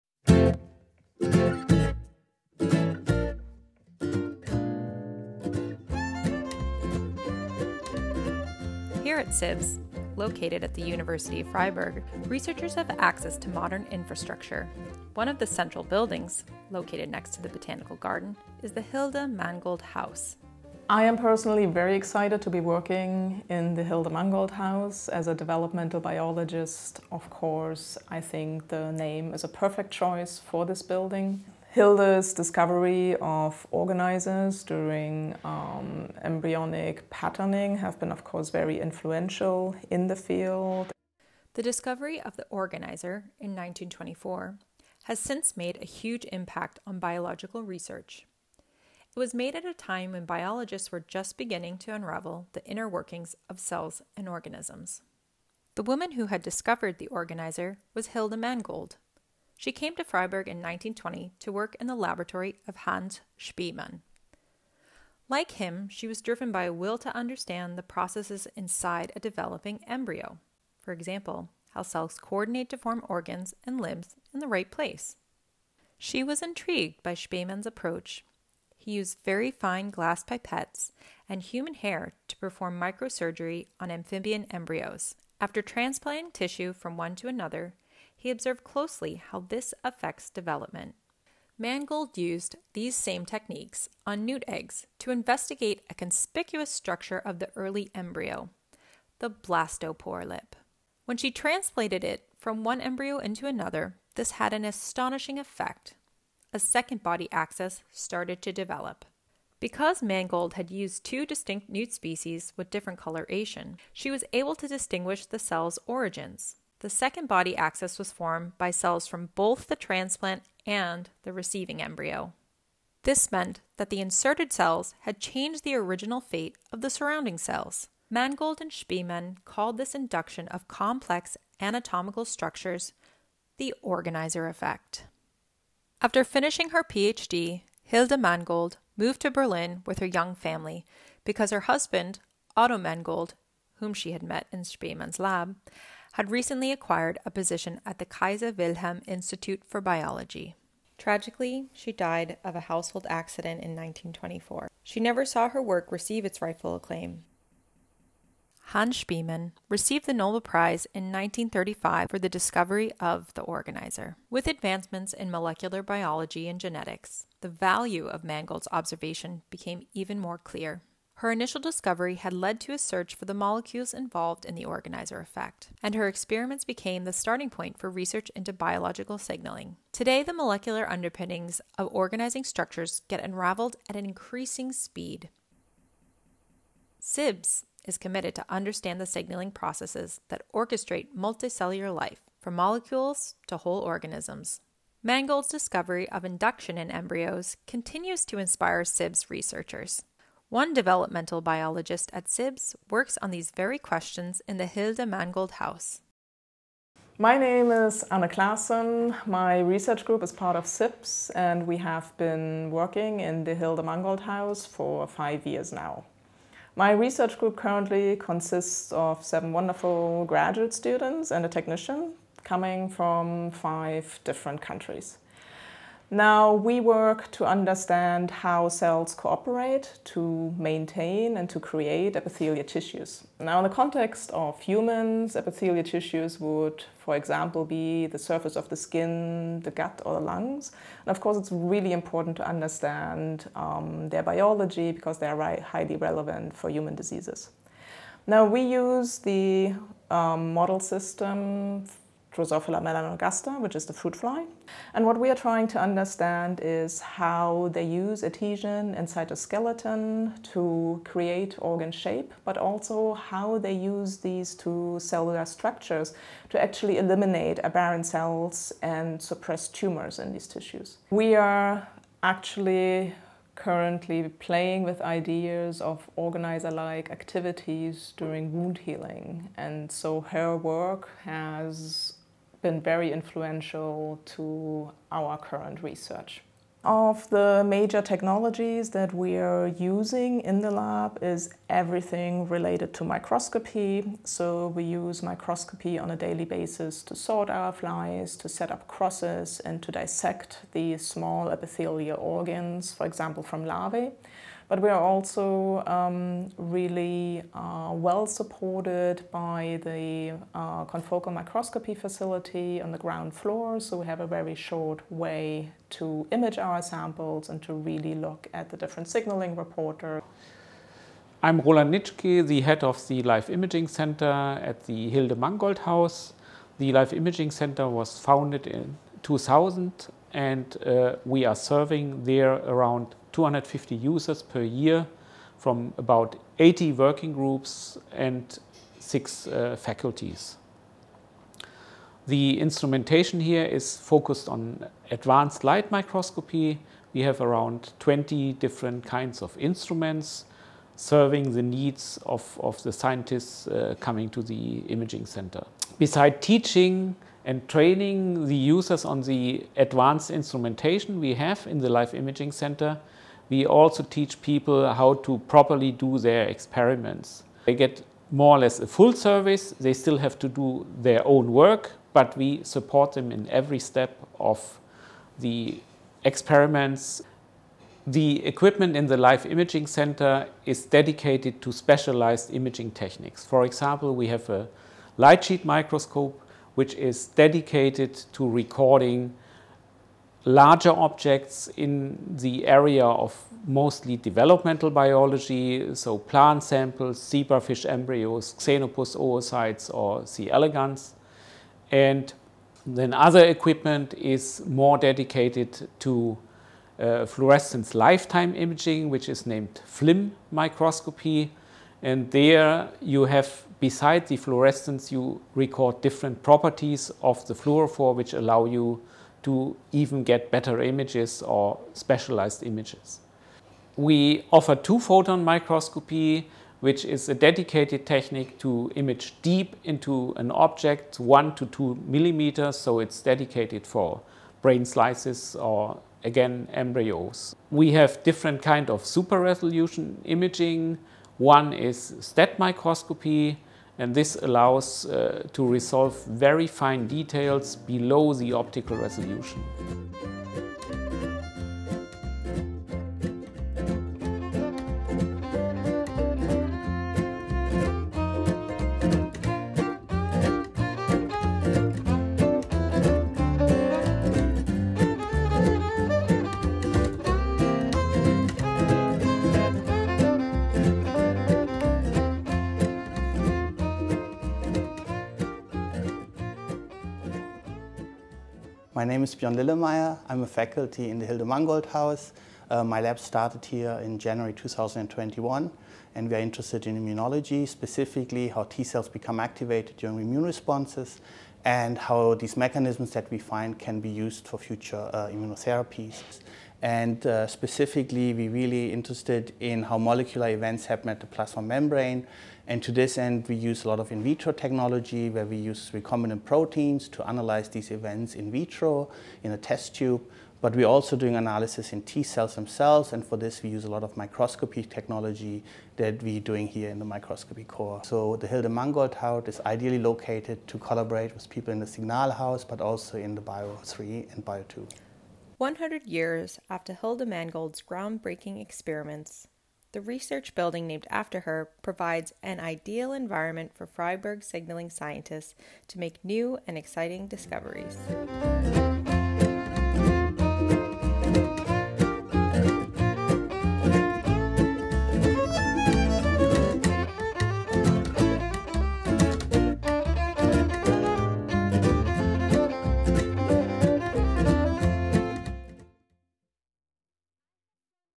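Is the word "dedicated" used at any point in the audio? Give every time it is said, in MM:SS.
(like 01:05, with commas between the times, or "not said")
06:20, 06:27, 06:44, 07:07, 07:13.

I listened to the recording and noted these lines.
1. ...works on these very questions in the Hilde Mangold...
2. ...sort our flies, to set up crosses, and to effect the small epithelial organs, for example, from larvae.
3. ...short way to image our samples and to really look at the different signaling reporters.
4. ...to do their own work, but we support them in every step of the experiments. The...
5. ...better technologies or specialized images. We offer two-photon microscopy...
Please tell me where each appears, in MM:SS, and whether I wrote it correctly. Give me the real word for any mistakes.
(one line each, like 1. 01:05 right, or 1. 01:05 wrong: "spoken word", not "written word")
1. 03:22 right
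2. 04:57 wrong: "dissect", not "effect"
3. 05:14 right
4. 06:10 right
5. 07:00 wrong: "images", not "technologies".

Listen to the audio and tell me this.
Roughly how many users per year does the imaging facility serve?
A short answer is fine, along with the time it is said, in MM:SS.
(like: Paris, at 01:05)
250, at 05:33.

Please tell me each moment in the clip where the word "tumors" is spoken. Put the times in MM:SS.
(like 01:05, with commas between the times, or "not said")
04:29.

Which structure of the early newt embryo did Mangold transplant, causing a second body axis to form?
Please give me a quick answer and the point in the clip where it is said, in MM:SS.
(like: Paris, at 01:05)
blastopore lip, at 01:39.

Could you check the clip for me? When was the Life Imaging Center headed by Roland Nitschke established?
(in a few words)
2000.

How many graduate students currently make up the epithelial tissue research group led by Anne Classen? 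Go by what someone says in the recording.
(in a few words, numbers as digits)
7.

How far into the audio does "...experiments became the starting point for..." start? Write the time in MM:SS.
02:56.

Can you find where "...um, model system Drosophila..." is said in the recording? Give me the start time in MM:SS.
04:10.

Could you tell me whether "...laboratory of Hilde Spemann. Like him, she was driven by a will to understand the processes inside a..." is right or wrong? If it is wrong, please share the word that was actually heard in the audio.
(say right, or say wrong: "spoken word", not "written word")
wrong: "Hans", not "Hilde".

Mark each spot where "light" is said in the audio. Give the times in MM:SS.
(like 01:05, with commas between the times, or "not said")
05:45, 06:25.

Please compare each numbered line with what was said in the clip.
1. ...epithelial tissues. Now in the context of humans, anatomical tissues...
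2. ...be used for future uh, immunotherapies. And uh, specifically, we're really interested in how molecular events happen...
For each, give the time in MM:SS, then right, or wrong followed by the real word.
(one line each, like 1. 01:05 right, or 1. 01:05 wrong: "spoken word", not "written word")
1. 03:52 wrong: "epithelial", not "anatomical"
2. 08:14 right.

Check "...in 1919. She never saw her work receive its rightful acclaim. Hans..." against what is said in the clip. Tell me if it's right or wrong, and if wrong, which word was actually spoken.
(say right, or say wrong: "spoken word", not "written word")
wrong: "1924", not "1919".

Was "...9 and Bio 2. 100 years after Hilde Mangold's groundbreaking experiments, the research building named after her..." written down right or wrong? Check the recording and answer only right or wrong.
wrong.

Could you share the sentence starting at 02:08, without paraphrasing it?
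Mangold and Spemann called this induction of complex anatomical structures the organizer effect.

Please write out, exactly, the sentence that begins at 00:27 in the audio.
Of course, I think the name is a perfect choice for this building.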